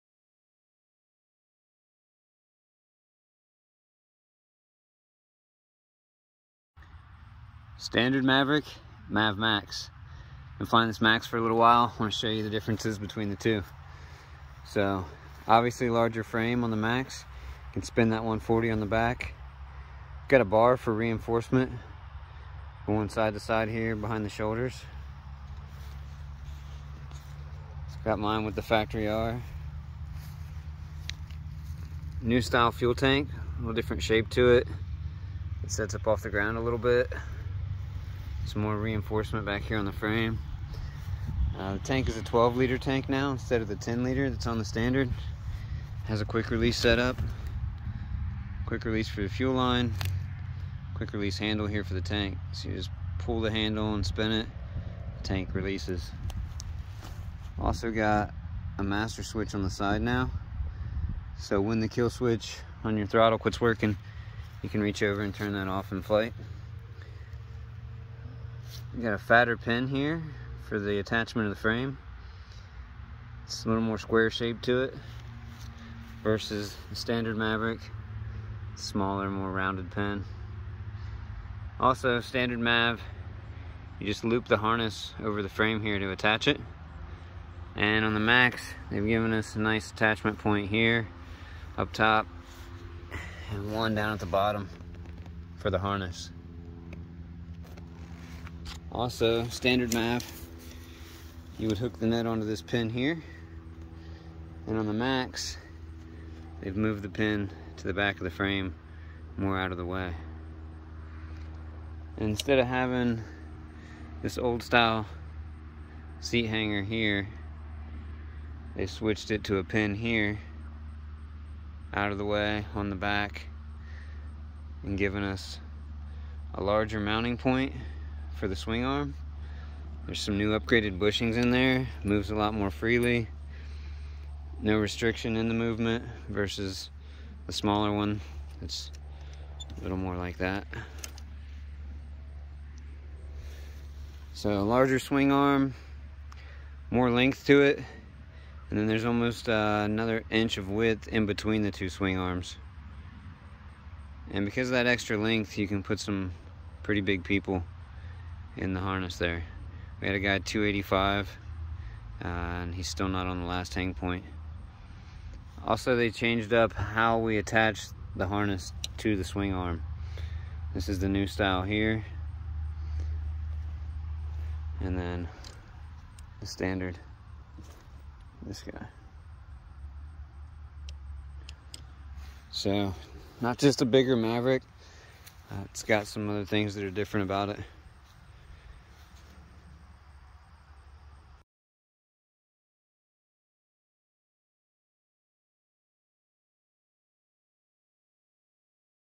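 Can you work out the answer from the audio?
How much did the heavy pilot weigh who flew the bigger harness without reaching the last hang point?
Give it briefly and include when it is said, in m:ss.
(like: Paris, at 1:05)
285, at 2:40.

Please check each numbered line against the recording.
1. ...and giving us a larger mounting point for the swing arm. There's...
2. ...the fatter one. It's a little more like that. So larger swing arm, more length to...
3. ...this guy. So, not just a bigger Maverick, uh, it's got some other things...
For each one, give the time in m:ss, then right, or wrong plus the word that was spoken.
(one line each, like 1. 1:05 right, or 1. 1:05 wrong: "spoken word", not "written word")
1. 2:04 right
2. 2:17 wrong: "smaller", not "fatter"
3. 2:58 right.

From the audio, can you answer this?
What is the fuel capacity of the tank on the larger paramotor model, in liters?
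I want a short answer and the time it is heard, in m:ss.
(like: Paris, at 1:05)
12 liters, at 0:42.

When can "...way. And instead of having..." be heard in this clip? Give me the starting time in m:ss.
1:49.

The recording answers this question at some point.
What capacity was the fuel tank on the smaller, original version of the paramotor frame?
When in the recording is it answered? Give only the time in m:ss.
0:43.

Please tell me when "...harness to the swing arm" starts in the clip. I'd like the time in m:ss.
2:48.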